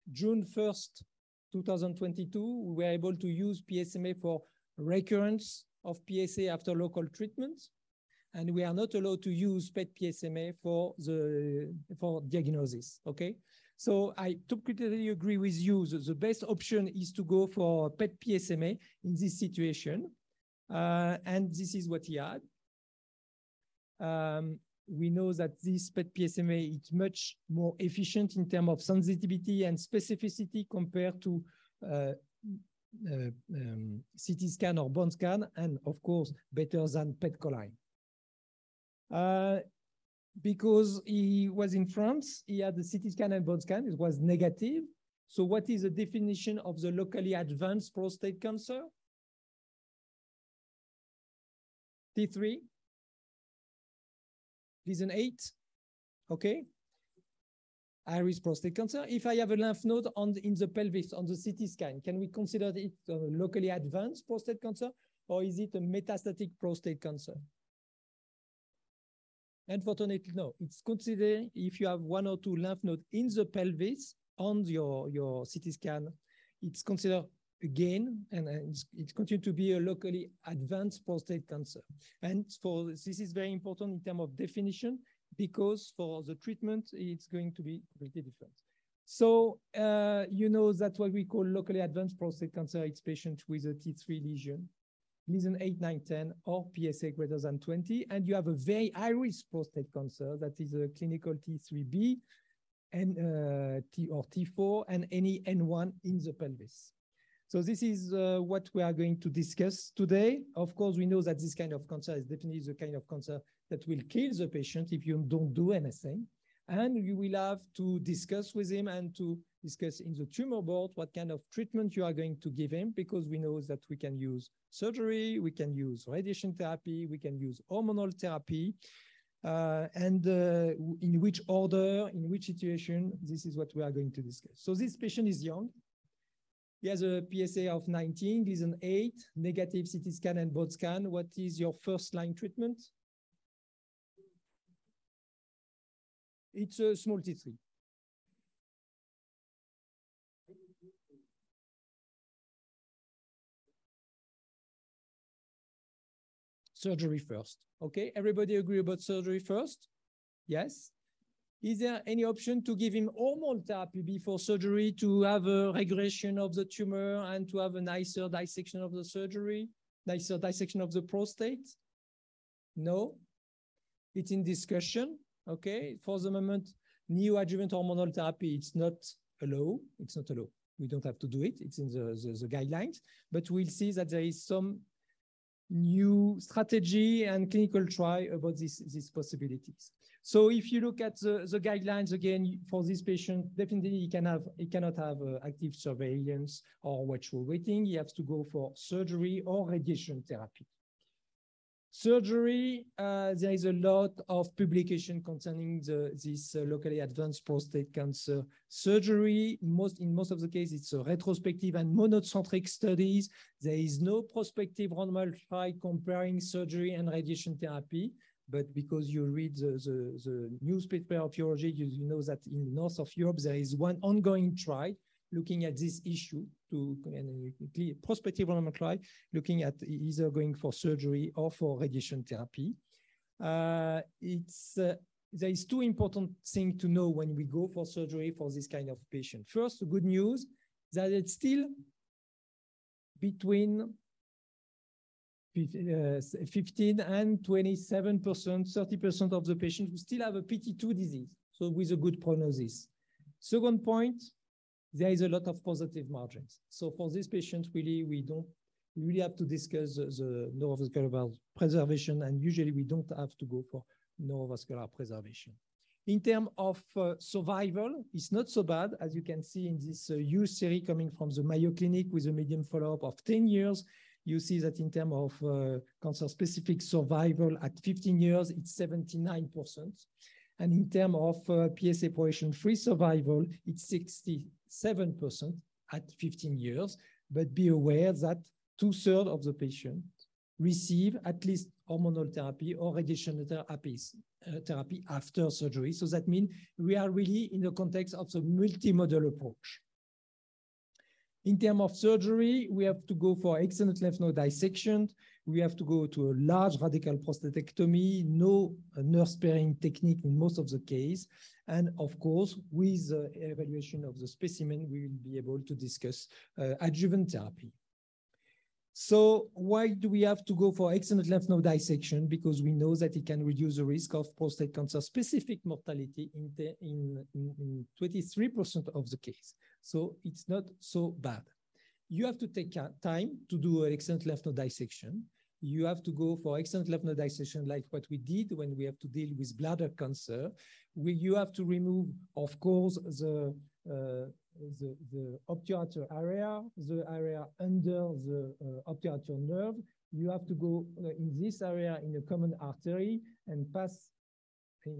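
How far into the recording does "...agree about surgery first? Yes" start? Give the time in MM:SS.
02:38.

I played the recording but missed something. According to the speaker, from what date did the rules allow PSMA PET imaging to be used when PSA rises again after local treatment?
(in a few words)
June 1st, 2022.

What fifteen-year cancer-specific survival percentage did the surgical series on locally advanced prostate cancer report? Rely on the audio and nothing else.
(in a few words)
79%.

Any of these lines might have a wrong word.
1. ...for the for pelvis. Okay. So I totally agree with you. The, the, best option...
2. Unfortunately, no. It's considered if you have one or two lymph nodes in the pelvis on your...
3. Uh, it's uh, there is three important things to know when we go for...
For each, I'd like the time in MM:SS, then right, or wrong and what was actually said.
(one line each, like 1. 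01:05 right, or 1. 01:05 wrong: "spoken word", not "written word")
1. 00:10 wrong: "diagnosis", not "pelvis"
2. 01:09 right
3. 03:53 wrong: "two", not "three".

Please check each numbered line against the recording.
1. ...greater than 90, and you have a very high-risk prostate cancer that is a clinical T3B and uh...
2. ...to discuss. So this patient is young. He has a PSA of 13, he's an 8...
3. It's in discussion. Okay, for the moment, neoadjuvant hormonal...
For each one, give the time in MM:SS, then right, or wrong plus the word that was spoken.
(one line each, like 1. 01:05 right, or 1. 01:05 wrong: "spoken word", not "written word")
1. 01:37 wrong: "20", not "90"
2. 02:14 wrong: "19", not "13"
3. 02:54 right.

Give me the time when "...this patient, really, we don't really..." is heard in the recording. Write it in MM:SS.
04:17.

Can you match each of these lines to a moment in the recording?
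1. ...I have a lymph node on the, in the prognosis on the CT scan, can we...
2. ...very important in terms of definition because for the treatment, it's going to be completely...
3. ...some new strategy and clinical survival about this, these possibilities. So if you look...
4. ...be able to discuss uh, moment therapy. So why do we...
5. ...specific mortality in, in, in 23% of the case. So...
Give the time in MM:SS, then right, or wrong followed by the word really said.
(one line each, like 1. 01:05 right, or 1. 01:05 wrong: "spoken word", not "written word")
1. 00:59 wrong: "pelvis", not "prognosis"
2. 01:23 right
3. 03:04 wrong: "trial", not "survival"
4. 05:15 wrong: "adjuvant", not "moment"
5. 05:25 right.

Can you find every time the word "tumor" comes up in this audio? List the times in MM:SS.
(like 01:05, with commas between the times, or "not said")
02:00, 02:46.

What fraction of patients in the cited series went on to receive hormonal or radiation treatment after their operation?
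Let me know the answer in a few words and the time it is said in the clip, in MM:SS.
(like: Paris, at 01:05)
two-thirds, at 04:48.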